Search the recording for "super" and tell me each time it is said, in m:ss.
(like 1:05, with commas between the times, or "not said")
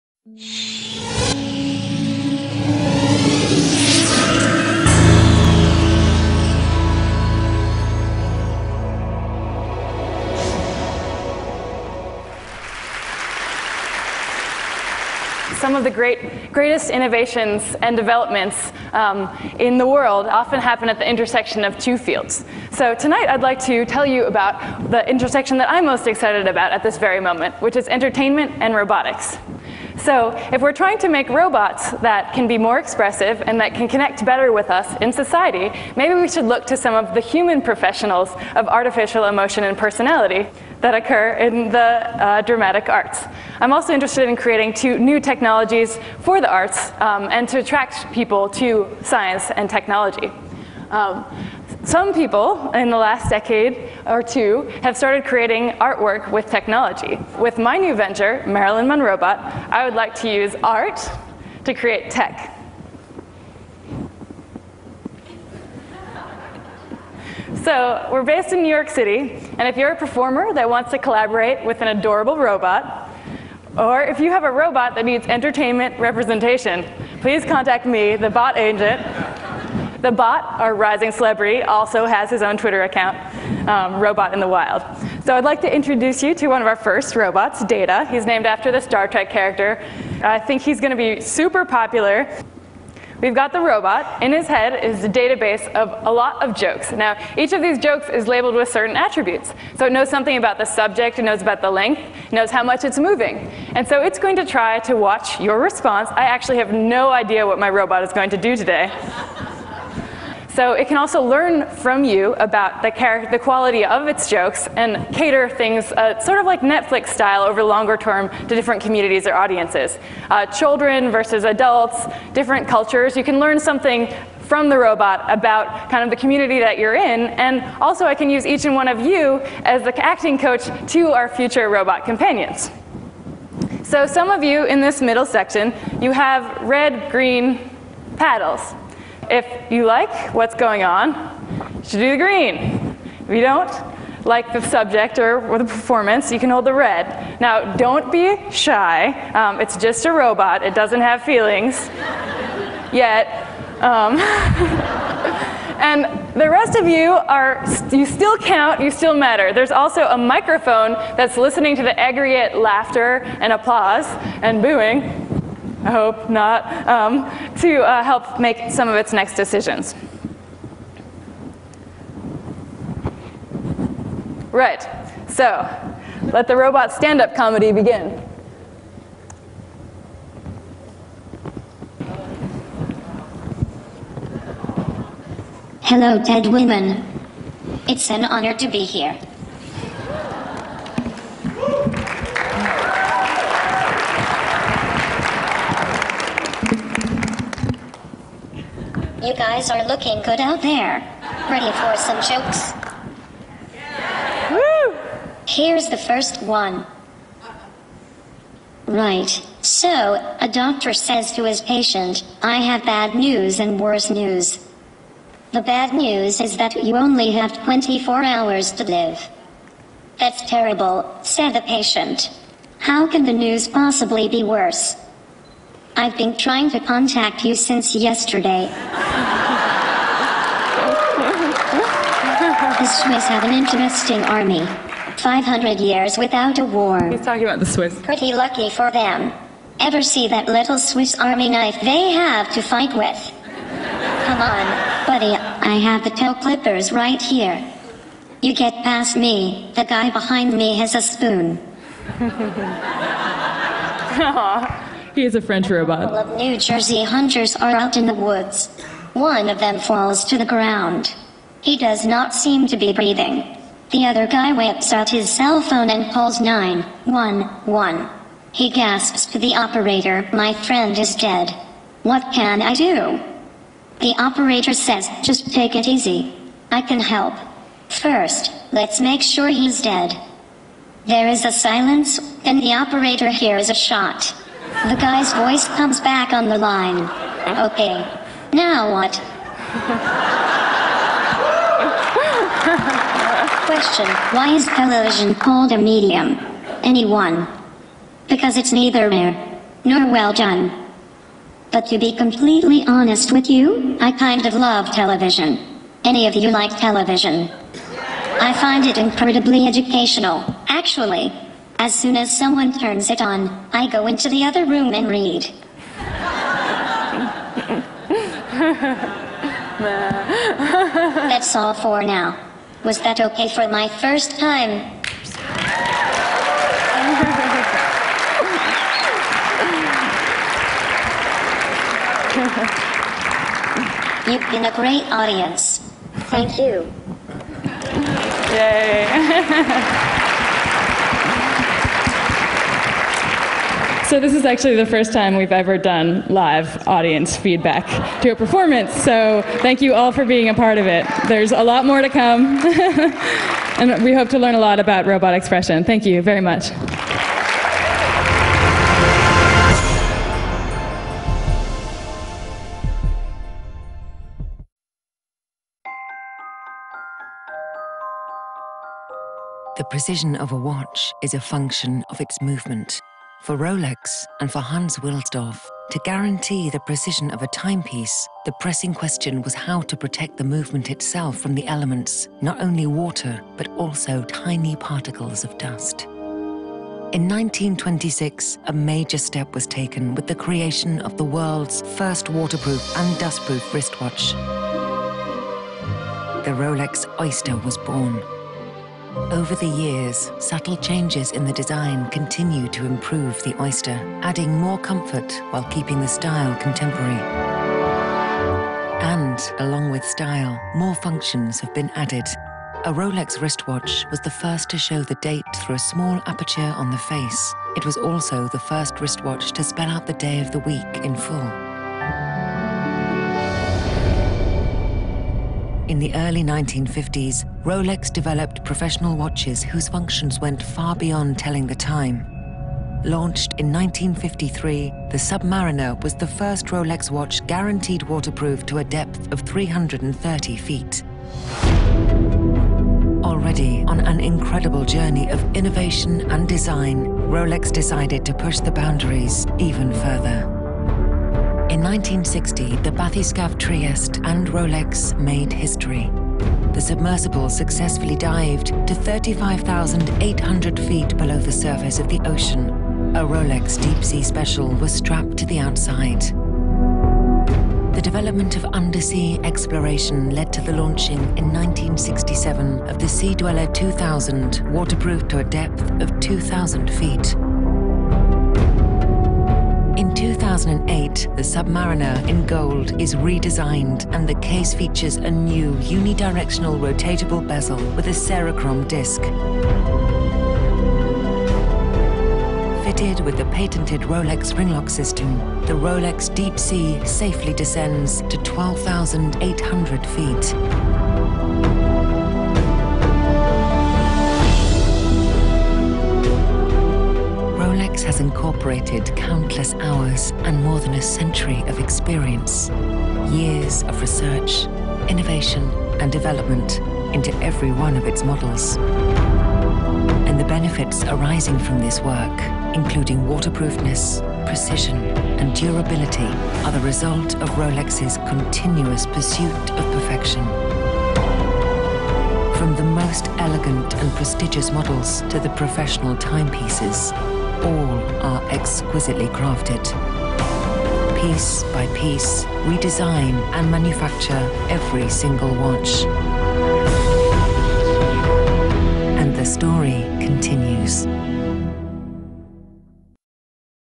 1:31.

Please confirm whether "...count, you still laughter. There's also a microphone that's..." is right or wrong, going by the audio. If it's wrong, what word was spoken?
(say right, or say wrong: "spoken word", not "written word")
wrong: "matter", not "laughter".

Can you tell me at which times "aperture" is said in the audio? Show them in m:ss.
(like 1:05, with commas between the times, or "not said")
6:56.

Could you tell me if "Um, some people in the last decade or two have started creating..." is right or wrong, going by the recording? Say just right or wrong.
right.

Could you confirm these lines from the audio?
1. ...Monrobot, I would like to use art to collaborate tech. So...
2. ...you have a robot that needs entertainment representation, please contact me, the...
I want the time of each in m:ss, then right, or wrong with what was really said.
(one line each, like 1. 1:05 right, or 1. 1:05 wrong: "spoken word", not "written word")
1. 0:58 wrong: "create", not "collaborate"
2. 1:14 right.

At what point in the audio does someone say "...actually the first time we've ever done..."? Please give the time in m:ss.
5:44.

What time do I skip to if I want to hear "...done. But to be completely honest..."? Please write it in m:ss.
5:00.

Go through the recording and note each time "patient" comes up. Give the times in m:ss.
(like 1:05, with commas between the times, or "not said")
3:31, 3:41.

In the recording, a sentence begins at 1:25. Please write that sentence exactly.
So I'd like to introduce you to one of our first robots, Data.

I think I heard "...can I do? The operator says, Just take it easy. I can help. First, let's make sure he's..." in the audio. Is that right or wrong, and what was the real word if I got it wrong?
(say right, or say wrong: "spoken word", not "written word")
right.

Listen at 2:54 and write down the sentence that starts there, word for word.
Right, so let the robot stand-up comedy begin.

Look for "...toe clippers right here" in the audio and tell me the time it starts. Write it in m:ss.
4:06.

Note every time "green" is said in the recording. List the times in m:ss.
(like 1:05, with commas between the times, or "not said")
2:17, 2:22.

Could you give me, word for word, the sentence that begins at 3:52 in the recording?
the Swiss have an interesting army.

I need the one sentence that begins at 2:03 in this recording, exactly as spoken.
You can learn something from the robot about kind of the community that you're in.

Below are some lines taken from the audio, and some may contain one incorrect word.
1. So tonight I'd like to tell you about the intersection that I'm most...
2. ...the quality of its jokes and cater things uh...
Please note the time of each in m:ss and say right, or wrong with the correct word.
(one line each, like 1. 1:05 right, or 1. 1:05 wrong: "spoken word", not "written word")
1. 0:22 right
2. 1:53 right.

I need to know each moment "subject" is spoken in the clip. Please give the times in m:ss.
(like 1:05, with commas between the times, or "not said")
1:40, 2:24.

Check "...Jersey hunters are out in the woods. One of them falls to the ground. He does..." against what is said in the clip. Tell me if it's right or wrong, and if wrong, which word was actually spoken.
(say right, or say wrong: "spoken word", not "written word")
right.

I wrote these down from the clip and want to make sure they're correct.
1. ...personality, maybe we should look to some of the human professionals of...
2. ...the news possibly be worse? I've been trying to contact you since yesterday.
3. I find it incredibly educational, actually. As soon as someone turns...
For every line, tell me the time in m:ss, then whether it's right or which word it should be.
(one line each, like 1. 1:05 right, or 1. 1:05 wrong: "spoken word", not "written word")
1. 0:35 wrong: "society", not "personality"
2. 3:43 right
3. 5:08 right.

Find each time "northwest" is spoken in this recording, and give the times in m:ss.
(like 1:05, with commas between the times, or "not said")
not said.